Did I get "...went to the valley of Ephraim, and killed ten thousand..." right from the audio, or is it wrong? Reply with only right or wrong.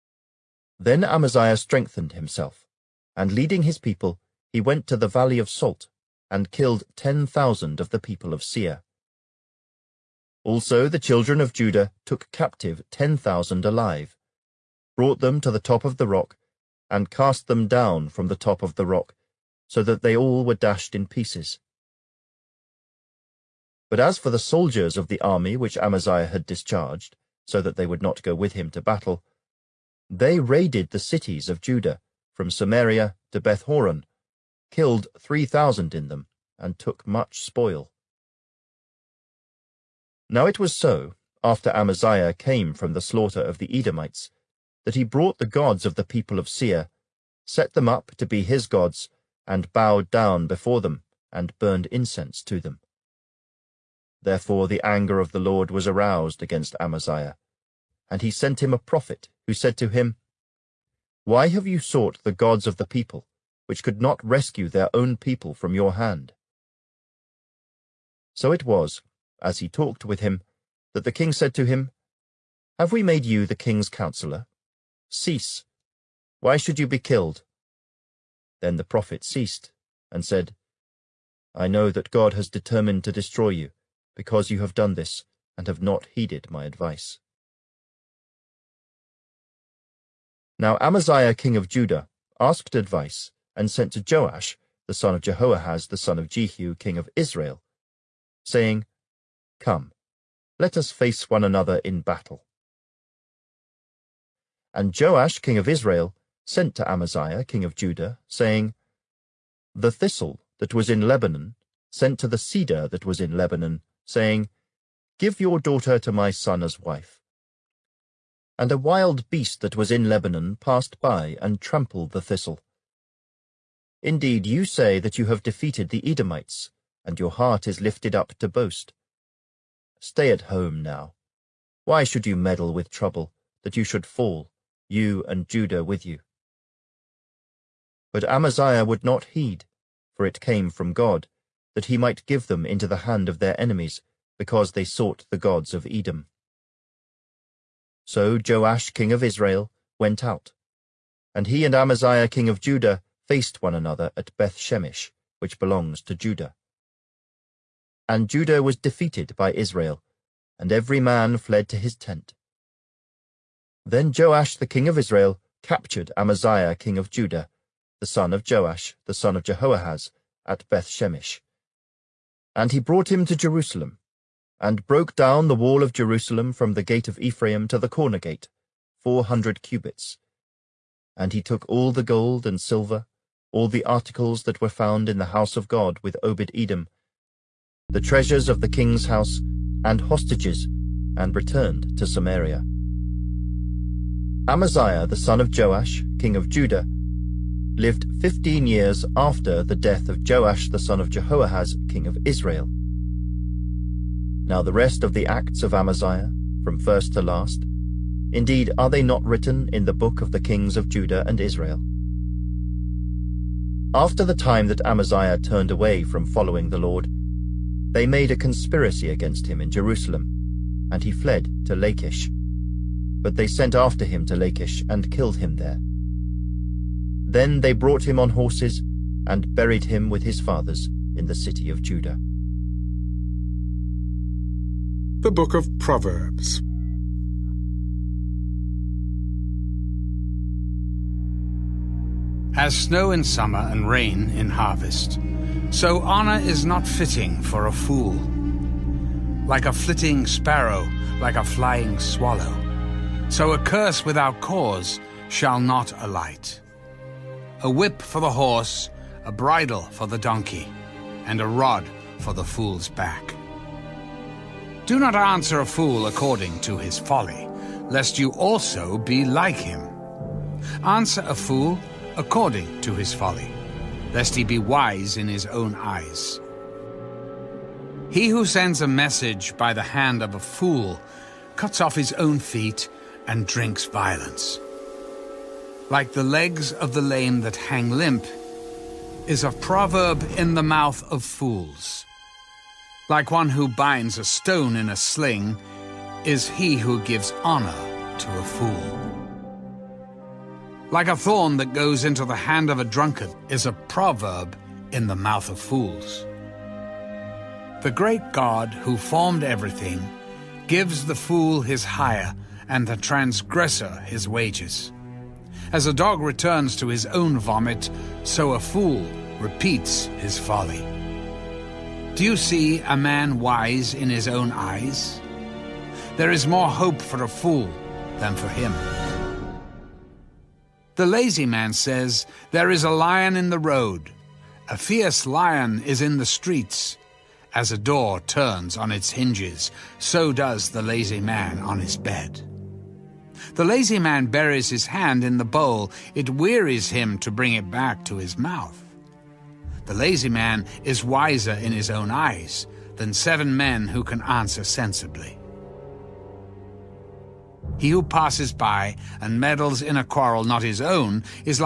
wrong.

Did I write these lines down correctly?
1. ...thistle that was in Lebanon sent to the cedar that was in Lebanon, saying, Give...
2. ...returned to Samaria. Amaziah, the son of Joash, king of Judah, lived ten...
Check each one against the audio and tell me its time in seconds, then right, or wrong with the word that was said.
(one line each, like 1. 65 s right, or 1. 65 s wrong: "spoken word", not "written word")
1. 109 s right
2. 191 s wrong: "fifteen", not "ten".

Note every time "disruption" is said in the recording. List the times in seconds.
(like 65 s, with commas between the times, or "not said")
not said.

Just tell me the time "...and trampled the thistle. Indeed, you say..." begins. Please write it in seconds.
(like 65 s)
121 s.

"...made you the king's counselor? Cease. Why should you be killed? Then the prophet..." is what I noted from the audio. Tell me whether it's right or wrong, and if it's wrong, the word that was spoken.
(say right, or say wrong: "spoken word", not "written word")
right.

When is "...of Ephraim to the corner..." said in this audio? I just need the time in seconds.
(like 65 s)
177 s.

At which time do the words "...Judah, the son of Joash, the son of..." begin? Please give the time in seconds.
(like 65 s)
167 s.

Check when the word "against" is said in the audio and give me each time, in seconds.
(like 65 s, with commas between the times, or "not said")
56 s, 219 s.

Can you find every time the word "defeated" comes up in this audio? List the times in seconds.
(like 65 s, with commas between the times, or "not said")
125 s, 158 s.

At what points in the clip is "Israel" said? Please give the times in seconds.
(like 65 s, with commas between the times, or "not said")
97 s, 105 s, 149 s, 159 s, 164 s, 202 s, 211 s.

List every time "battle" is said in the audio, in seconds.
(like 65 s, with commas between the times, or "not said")
28 s, 102 s.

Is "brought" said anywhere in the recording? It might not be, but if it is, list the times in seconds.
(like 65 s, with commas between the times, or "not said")
14 s, 45 s, 172 s, 227 s.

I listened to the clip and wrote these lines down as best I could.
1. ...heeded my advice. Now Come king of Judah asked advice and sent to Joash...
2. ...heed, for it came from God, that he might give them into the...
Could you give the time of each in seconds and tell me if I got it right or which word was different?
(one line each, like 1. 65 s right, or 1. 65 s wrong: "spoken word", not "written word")
1. 86 s wrong: "Amaziah", not "Come"
2. 139 s right.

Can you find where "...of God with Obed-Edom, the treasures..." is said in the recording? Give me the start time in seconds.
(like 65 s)
185 s.